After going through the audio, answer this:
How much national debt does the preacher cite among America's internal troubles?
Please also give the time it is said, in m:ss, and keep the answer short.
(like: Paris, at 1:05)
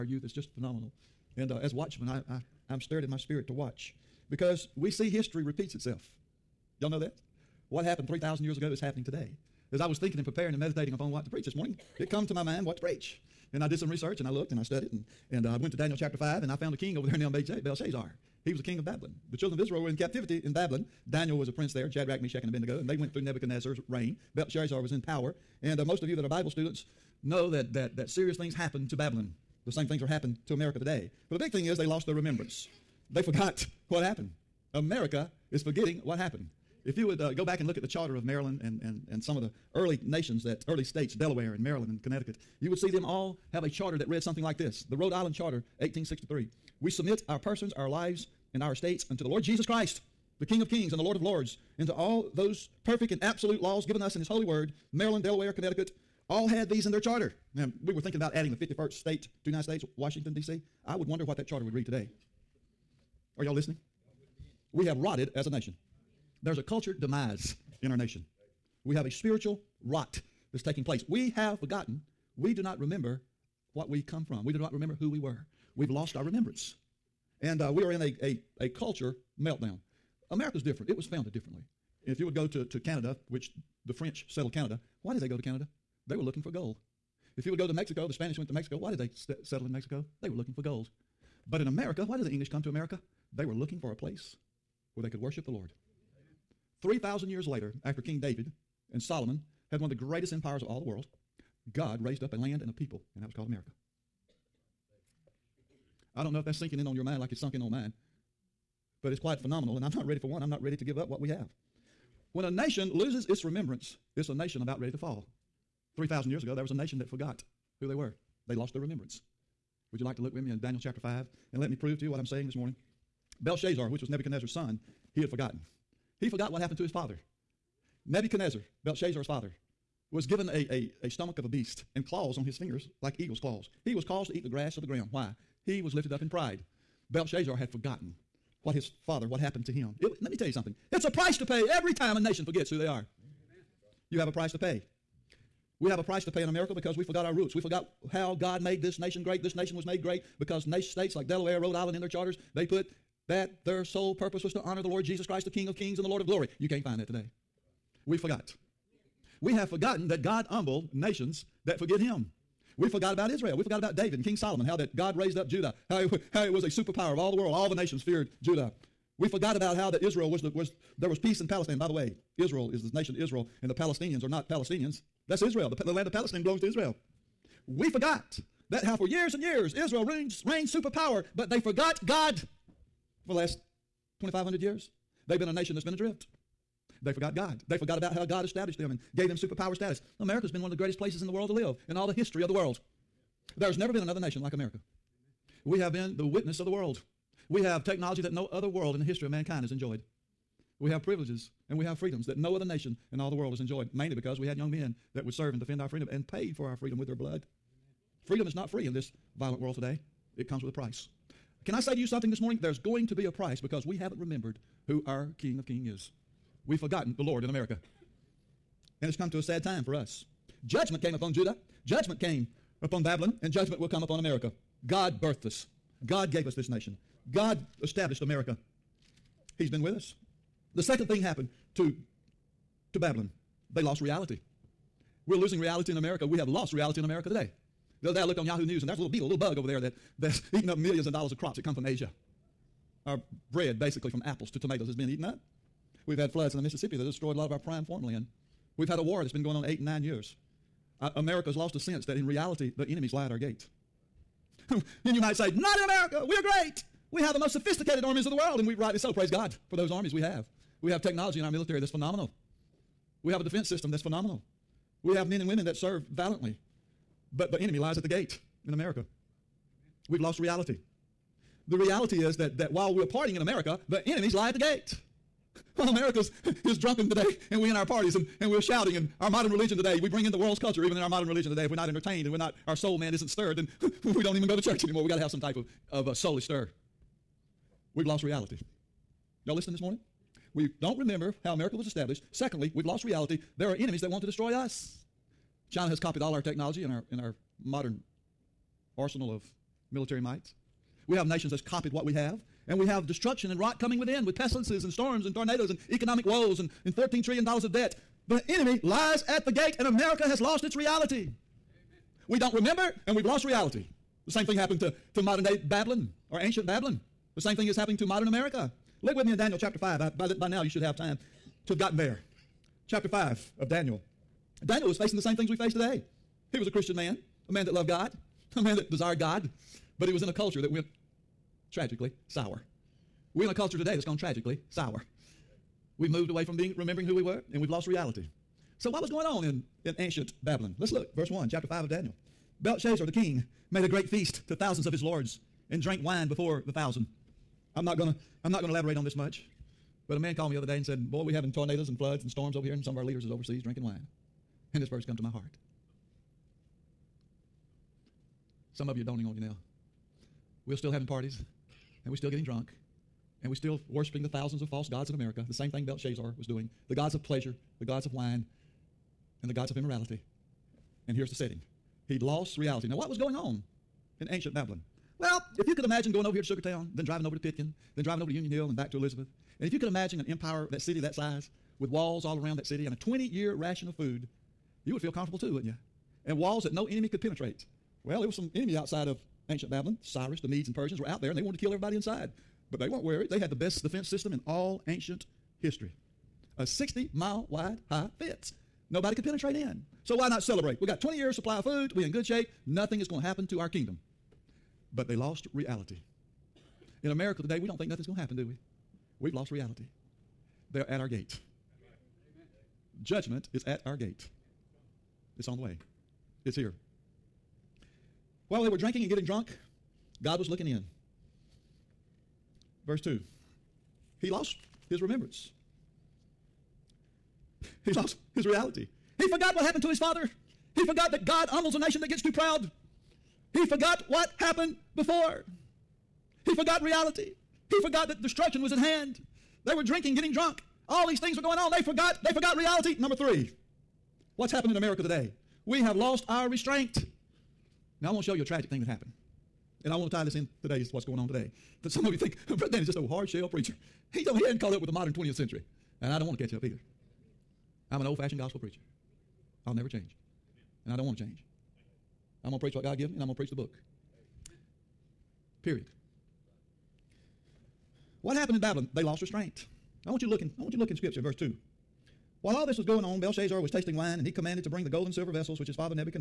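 $14 trillion, at 5:06.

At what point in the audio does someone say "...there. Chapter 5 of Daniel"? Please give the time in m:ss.
5:21.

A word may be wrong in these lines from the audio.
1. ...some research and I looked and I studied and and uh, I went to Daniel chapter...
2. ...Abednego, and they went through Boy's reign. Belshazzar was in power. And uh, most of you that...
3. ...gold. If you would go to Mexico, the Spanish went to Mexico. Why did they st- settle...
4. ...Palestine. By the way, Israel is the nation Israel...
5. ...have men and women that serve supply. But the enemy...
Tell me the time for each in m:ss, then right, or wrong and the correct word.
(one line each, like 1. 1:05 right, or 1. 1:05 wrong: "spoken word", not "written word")
1. 0:13 right
2. 0:22 wrong: "Nebuchadnezzar", not "Boy"
3. 1:26 right
4. 2:51 right
5. 4:25 wrong: "valiantly", not "supply".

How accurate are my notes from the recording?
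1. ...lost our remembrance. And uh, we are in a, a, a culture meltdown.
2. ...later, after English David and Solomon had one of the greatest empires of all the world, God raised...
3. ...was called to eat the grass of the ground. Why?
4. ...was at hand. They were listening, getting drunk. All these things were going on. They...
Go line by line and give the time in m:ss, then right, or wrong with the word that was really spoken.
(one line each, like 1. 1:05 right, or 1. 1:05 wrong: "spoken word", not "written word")
1. 1:15 right
2. 1:37 wrong: "King", not "English"
3. 2:13 wrong: "caused", not "called"
4. 7:18 wrong: "drinking", not "listening".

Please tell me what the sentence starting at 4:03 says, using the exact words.
Our bread, basically from apples to tomatoes, has been eaten up.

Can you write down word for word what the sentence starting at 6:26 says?
And walls that no enemy could penetrate.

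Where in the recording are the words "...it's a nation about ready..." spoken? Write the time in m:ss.
1:54.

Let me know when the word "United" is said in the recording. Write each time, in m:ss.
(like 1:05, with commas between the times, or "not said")
0:59.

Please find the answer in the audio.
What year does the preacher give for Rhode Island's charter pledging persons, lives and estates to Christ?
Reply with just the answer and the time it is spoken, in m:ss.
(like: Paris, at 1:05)
1863, at 0:45.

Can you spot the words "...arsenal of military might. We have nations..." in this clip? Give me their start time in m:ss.
4:58.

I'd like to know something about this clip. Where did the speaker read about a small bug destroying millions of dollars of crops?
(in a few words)
Yahoo News.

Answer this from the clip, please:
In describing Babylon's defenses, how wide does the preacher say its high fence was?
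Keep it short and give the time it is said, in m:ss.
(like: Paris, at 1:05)
60 miles, at 6:36.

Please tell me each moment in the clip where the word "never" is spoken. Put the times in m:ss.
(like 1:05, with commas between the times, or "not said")
3:13, 7:39.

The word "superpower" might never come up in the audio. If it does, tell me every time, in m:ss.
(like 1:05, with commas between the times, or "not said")
2:46, 3:00, 3:09.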